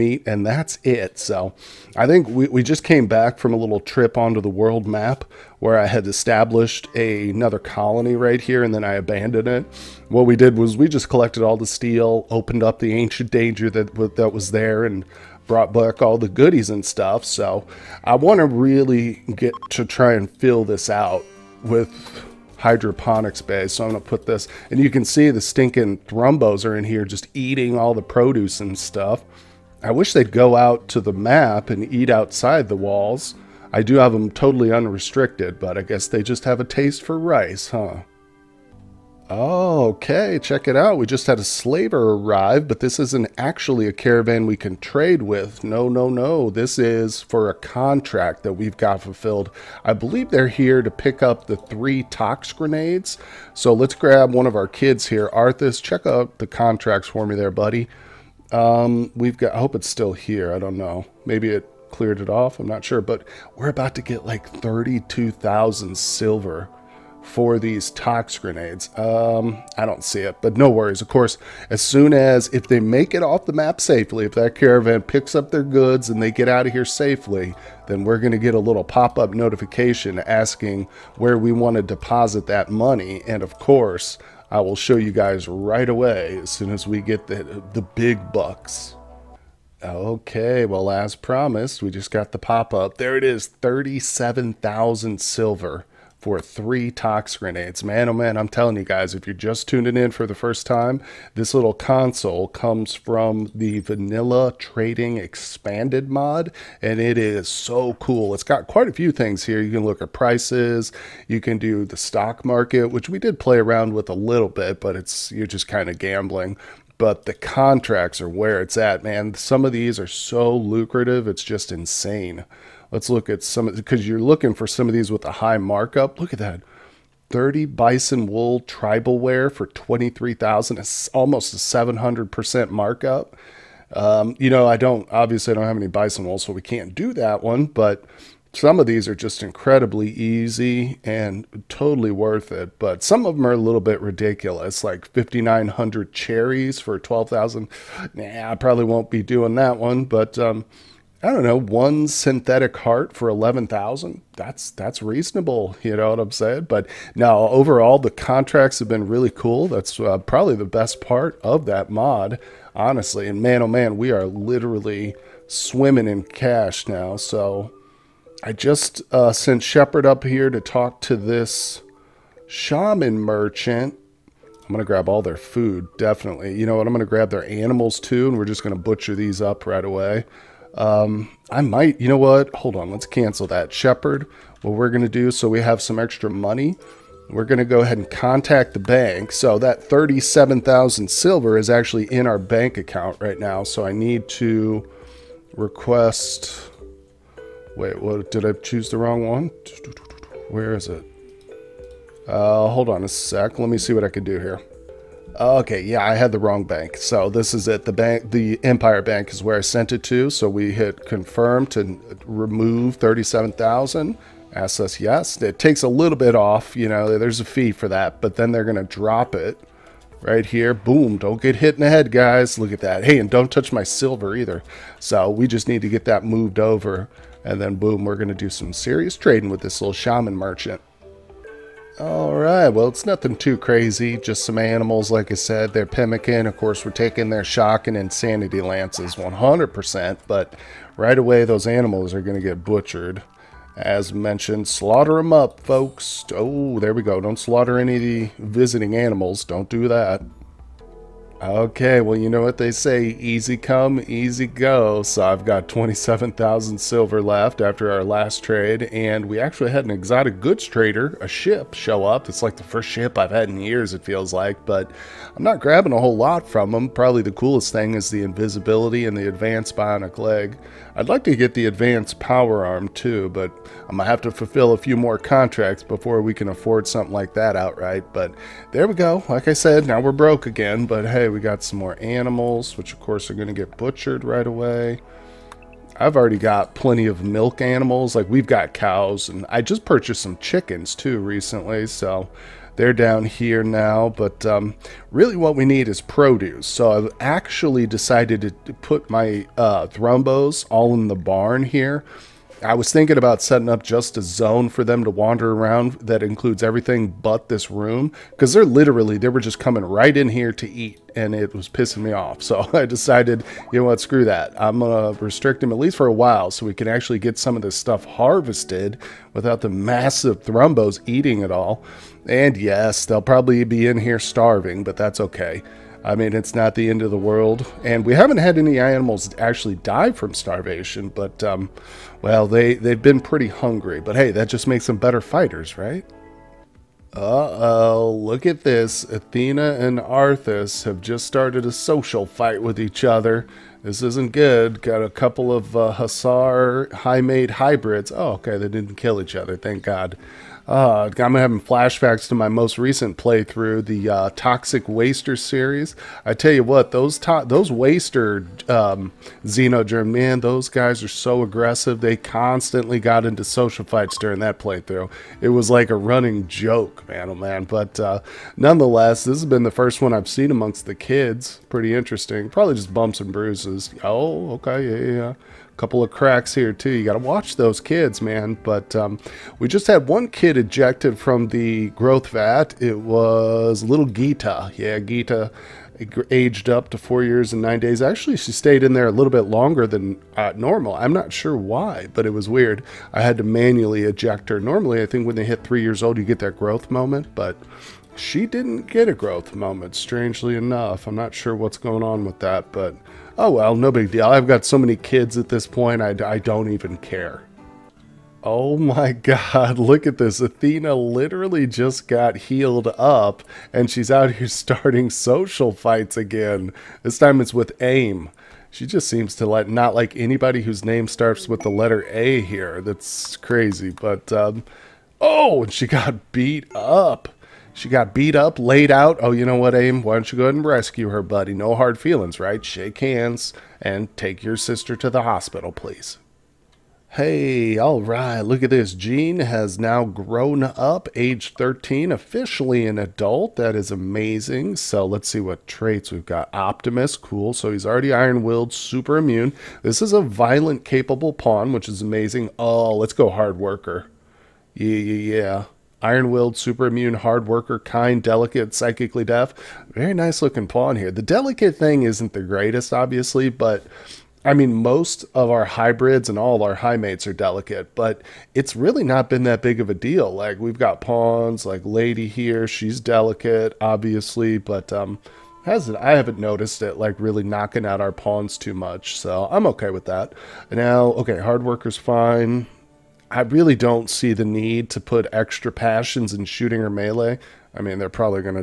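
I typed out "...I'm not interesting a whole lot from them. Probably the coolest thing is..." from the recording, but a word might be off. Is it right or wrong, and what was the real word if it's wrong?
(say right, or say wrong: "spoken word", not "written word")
wrong: "grabbing", not "interesting".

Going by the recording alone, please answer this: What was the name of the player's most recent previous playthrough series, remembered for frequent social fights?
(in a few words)
Toxic Waster.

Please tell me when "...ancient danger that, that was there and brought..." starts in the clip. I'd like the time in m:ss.
0:12.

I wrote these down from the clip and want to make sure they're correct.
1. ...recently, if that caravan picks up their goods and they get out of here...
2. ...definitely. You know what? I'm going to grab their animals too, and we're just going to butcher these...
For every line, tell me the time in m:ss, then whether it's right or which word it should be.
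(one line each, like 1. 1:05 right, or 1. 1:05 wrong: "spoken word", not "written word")
1. 1:13 wrong: "safely", not "recently"
2. 2:55 right.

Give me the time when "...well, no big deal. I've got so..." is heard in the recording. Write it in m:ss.
6:43.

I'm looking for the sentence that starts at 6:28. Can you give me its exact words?
Actually, she stayed in there a little bit longer than uh, normal.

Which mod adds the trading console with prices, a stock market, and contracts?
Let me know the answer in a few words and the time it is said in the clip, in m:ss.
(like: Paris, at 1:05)
Vanilla Trading Expanded, at 1:43.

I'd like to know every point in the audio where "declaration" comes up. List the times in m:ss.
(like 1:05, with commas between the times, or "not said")
not said.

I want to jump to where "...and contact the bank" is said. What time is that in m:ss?
3:07.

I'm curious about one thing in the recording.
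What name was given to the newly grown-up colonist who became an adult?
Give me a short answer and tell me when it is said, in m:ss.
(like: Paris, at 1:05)
Optimus, at 7:26.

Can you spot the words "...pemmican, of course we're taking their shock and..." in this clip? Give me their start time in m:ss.
3:55.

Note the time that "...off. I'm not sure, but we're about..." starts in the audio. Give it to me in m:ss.
1:02.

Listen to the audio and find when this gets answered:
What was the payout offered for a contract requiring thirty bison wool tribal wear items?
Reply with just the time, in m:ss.
2:09.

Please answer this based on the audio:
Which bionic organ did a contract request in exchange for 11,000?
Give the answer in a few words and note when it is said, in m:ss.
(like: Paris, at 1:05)
synthetic heart, at 2:32.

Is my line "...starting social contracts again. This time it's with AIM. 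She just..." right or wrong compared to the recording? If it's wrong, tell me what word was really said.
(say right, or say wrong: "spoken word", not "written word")
wrong: "fights", not "contracts".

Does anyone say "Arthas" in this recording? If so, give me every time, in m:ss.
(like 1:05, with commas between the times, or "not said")
0:55, 5:39.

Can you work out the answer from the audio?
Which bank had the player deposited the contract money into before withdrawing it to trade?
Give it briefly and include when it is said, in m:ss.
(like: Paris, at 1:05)
Empire Bank, at 3:28.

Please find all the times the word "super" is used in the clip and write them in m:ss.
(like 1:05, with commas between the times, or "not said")
7:28, 7:36.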